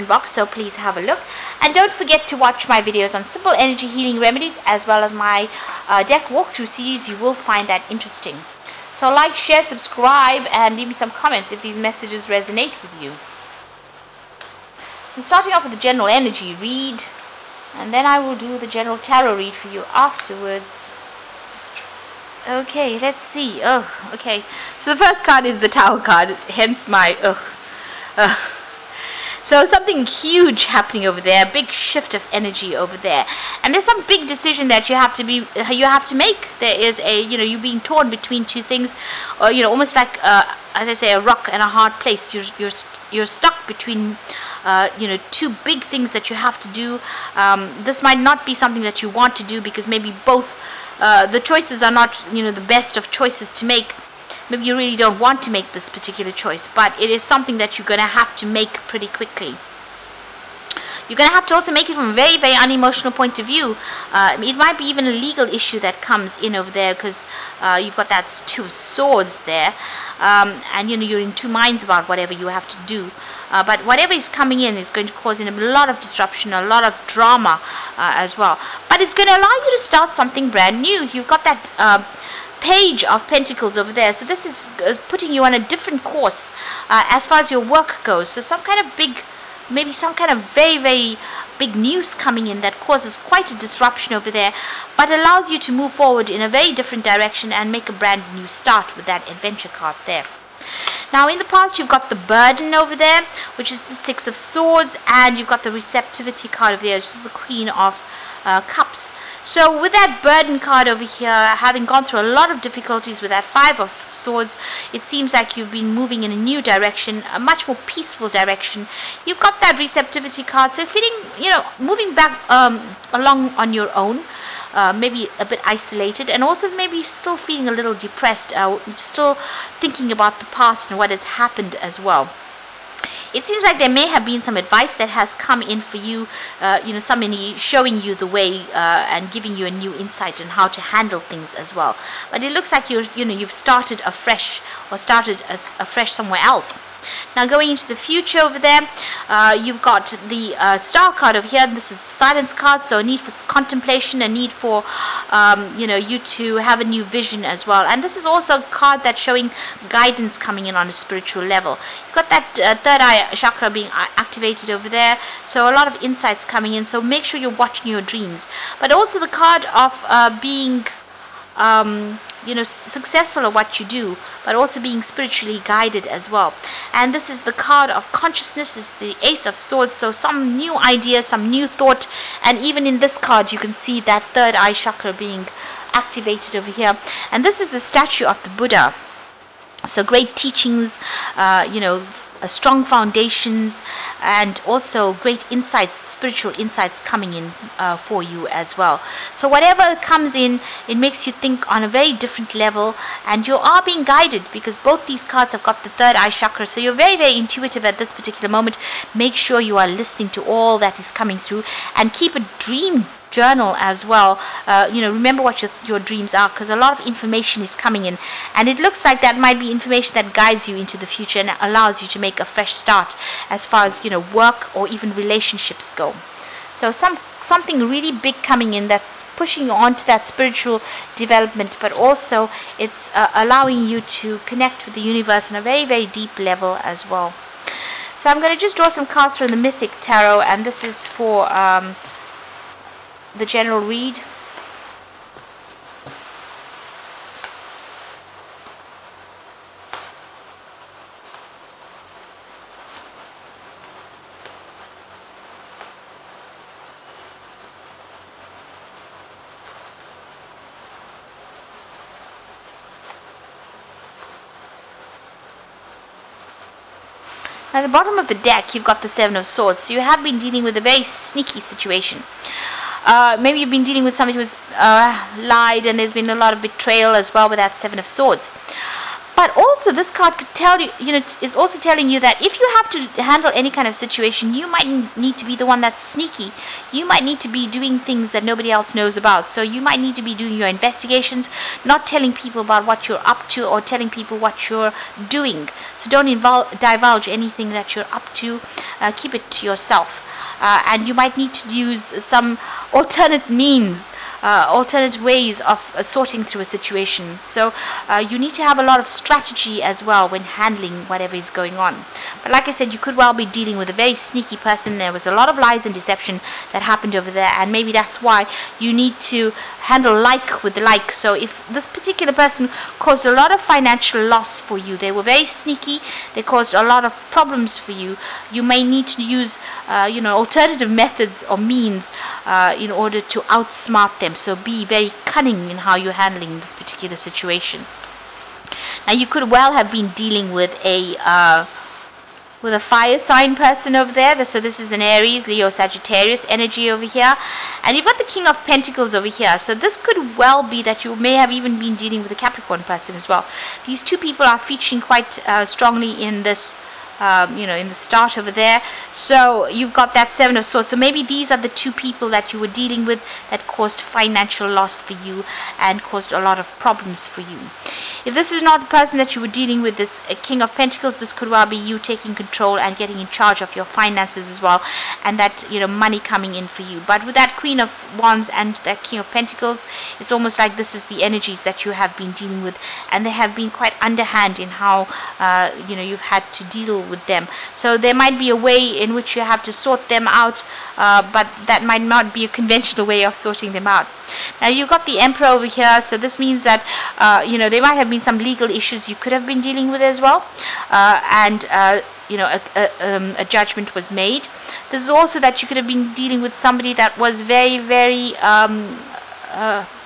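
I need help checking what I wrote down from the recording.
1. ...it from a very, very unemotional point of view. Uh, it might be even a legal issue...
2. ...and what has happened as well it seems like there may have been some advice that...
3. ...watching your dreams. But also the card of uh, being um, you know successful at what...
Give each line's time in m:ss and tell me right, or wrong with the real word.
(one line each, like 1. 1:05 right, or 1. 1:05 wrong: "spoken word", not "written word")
1. 1:01 right
2. 2:10 right
3. 2:47 right.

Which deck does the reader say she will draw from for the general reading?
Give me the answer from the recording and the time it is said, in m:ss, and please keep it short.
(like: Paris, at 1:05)
The Mythic Tarot, at 3:59.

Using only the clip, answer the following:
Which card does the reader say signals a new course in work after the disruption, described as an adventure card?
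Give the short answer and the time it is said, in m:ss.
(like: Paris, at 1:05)
Page of Pentacles, at 1:22.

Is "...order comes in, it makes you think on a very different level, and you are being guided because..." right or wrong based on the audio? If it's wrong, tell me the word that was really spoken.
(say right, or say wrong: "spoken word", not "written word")
wrong: "whatever", not "order".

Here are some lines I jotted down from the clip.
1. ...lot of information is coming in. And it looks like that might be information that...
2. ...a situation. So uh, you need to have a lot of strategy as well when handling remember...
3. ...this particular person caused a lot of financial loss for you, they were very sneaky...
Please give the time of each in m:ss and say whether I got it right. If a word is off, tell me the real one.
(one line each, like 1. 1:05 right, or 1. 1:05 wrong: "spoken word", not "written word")
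1. 3:36 right
2. 5:06 wrong: "whatever", not "remember"
3. 5:21 right.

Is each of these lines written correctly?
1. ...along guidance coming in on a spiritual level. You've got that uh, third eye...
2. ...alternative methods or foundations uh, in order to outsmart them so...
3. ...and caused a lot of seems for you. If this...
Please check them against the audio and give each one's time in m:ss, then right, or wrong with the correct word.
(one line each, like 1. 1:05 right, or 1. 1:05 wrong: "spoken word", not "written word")
1. 2:39 wrong: "showing", not "along"
2. 5:30 wrong: "means", not "foundations"
3. 6:05 wrong: "problems", not "seems".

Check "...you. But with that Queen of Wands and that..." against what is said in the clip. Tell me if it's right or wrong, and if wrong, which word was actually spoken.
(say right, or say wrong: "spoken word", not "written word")
right.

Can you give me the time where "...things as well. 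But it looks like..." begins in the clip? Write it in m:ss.
2:21.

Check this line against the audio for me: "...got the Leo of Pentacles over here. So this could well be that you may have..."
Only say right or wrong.
wrong.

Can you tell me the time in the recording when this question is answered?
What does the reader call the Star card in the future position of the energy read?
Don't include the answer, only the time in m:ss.
2:32.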